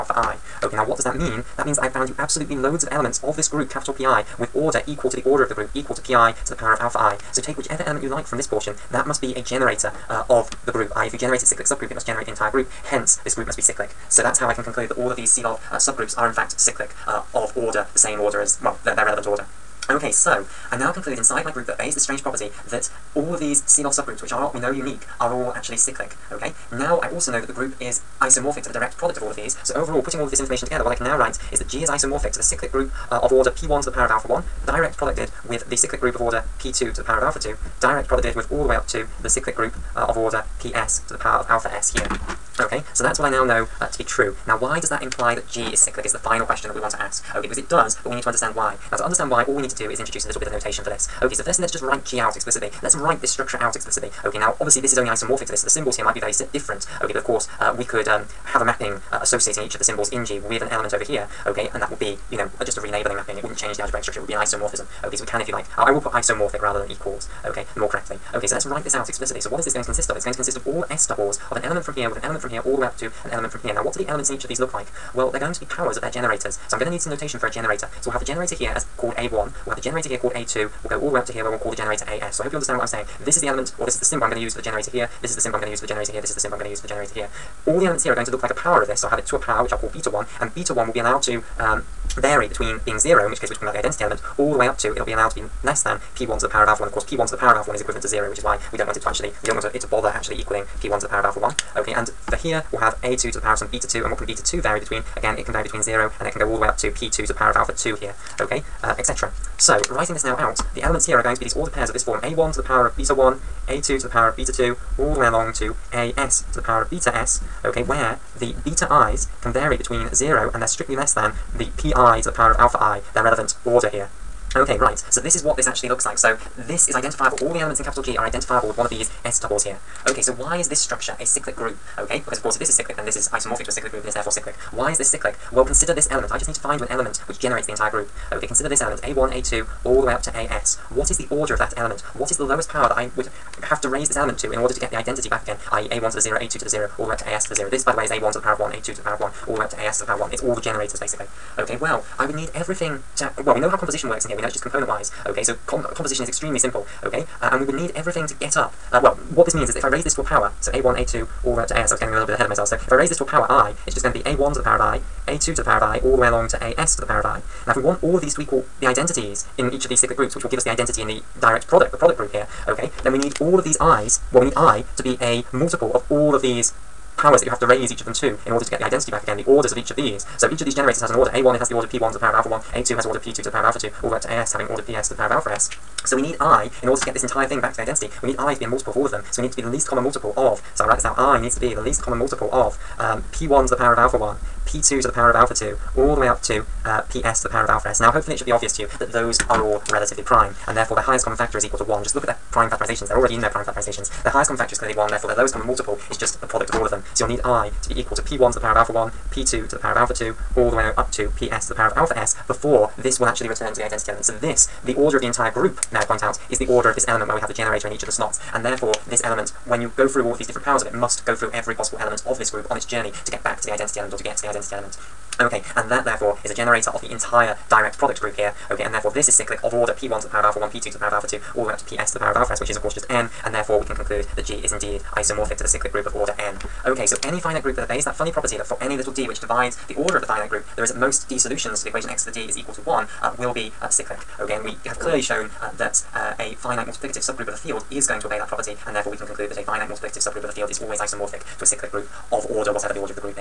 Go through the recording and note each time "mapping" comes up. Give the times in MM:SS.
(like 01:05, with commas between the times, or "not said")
00:58, 01:03.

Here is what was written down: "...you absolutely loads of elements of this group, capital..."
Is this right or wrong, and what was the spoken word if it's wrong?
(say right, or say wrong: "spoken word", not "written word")
right.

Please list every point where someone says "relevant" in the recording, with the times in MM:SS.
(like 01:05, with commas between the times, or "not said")
00:19, 02:03.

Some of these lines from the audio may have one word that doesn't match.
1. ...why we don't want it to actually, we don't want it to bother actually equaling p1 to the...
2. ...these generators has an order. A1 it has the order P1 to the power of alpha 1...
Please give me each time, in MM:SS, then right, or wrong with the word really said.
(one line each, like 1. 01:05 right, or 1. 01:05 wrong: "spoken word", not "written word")
1. 01:38 right
2. 03:00 right.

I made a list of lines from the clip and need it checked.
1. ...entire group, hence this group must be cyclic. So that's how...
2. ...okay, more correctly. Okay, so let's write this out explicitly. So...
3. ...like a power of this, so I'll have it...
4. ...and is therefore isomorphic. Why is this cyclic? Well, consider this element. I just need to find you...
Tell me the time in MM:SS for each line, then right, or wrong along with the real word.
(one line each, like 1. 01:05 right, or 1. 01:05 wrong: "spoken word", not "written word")
1. 00:12 right
2. 01:07 right
3. 01:28 right
4. 02:14 wrong: "cyclic", not "isomorphic".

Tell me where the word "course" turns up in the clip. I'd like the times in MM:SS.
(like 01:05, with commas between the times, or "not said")
00:57, 01:36, 02:12, 03:52.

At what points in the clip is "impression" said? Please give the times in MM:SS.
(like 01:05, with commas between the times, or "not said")
not said.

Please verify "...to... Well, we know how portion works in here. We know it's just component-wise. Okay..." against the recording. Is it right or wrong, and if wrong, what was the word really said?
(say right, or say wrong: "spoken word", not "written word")
wrong: "composition", not "portion".